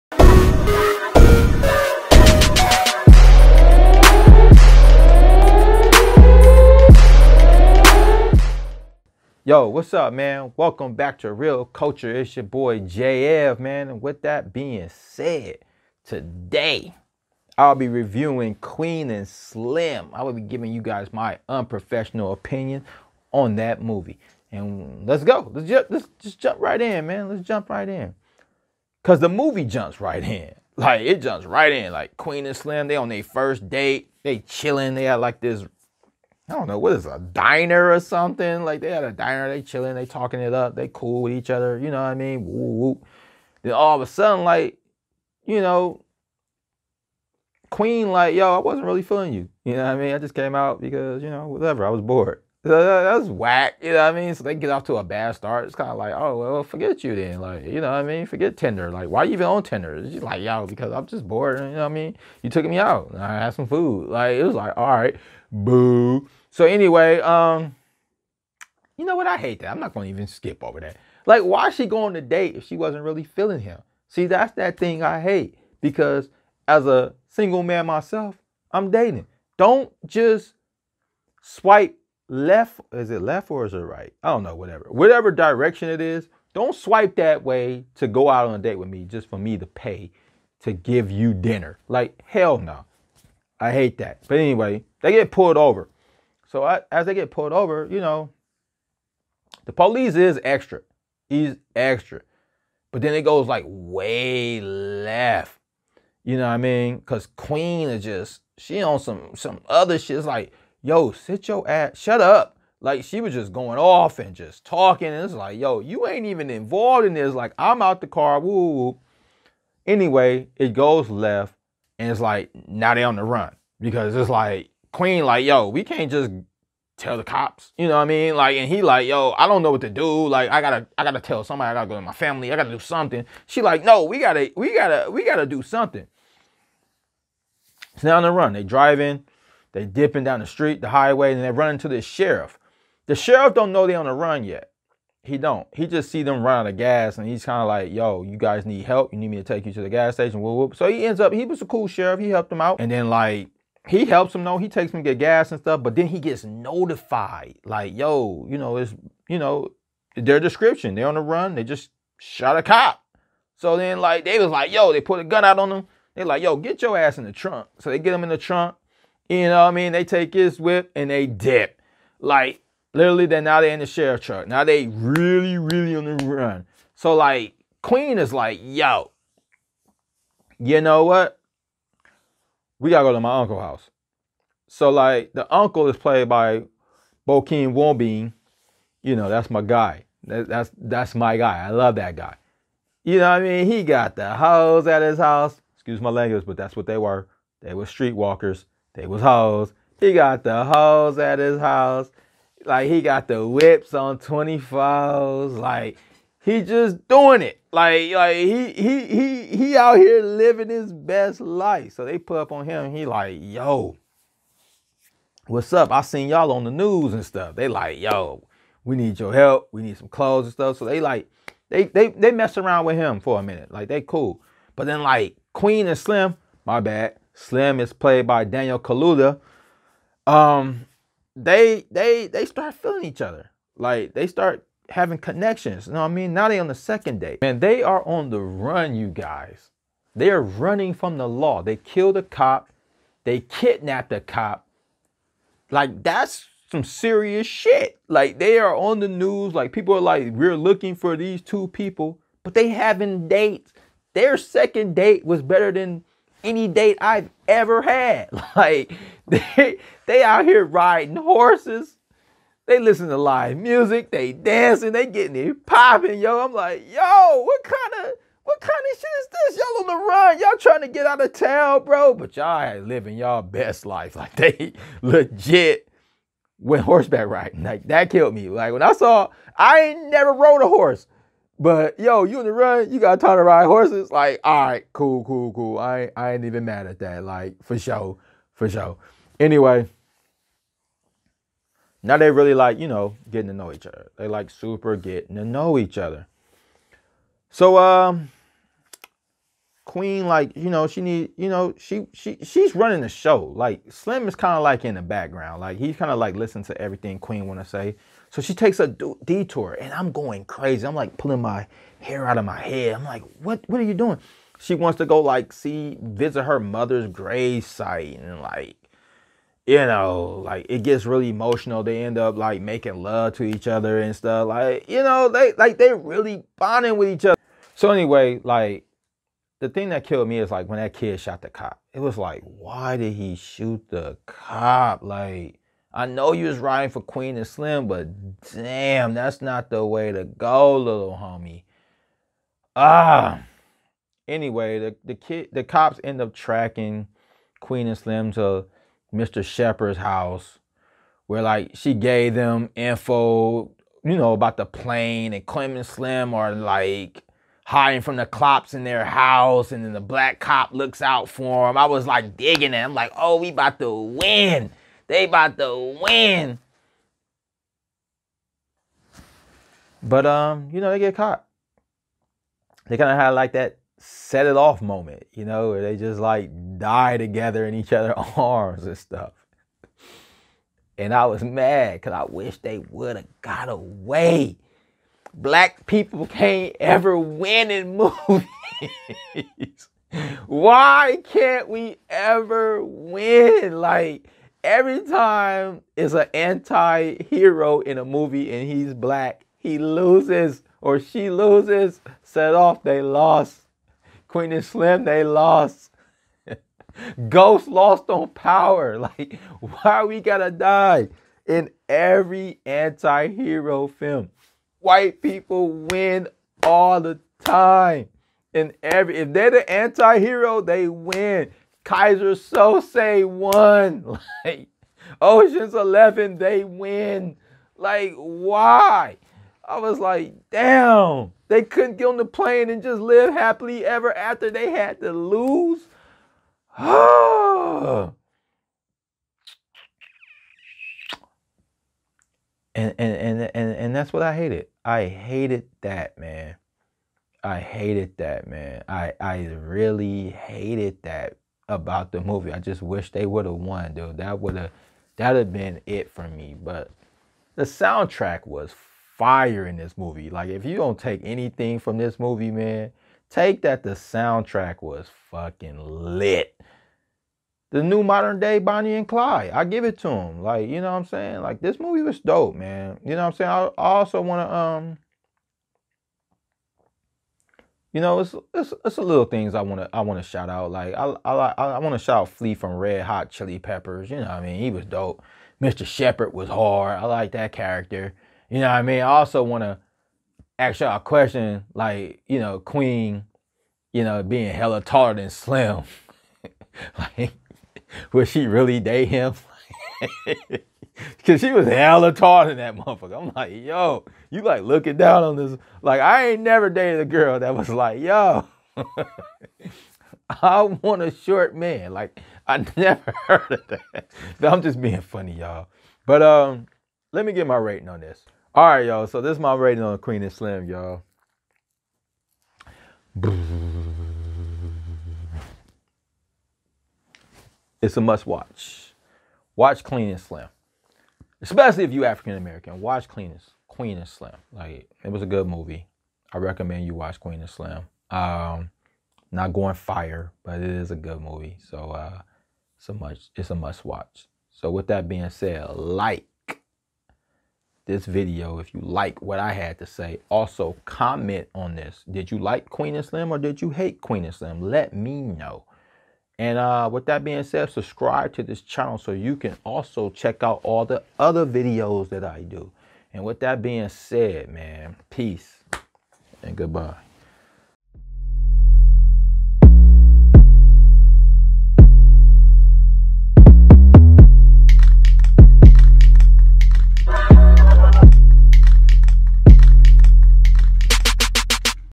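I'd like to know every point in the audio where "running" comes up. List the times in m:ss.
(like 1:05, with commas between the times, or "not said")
4:00, 5:02.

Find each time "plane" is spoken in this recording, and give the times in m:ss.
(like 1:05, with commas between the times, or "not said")
5:54, 7:12.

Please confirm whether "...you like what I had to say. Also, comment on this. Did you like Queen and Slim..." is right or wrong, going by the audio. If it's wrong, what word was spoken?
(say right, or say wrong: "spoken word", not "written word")
right.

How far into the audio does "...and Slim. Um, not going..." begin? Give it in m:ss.
8:57.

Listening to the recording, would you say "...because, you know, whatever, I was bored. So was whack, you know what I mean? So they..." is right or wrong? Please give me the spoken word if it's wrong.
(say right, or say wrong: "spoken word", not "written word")
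right.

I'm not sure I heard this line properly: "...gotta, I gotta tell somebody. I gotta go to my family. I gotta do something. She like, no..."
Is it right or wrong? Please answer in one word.
right.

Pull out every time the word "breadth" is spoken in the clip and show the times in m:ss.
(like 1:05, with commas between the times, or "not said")
not said.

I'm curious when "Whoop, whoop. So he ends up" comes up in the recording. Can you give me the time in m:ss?
2:30.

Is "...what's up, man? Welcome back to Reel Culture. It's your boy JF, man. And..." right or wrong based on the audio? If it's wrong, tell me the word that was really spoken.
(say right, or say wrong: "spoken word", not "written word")
right.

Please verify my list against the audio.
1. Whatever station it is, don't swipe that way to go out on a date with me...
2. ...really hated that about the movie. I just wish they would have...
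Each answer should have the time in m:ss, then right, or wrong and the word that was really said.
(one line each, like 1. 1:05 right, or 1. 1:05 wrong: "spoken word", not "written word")
1. 1:24 wrong: "direction", not "station"
2. 7:29 right.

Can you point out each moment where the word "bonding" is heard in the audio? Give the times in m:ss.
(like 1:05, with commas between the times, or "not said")
5:26.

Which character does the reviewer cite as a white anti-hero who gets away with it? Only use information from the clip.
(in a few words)
Keyser Söze.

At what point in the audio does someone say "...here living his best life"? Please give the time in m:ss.
3:29.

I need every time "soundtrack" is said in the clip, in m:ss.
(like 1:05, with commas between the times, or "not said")
7:37, 7:43.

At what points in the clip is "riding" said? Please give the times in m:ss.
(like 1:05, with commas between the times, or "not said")
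4:20, 4:37, 5:36.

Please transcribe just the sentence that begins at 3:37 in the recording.
They like, yo, we need your help.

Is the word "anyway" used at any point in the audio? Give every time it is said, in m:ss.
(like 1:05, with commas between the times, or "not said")
1:06, 1:34, 1:59, 4:49, 5:27, 5:44.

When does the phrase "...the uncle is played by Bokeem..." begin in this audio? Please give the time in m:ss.
3:05.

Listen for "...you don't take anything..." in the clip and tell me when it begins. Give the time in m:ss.
7:40.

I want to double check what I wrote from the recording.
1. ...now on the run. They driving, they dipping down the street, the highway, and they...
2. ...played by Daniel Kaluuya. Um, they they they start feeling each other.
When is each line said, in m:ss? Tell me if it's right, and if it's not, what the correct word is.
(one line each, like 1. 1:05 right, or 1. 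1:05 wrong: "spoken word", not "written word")
1. 2:18 right
2. 3:47 right.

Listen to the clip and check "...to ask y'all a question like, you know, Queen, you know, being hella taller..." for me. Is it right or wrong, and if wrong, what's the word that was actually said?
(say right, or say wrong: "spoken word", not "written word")
right.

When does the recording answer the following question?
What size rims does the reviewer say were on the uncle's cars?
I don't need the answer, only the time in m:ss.
3:24.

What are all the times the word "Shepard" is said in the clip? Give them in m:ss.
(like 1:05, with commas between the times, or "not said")
5:49, 8:05.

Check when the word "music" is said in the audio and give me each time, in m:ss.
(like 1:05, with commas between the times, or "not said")
4:23.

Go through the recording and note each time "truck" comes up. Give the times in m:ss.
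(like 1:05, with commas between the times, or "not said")
2:54.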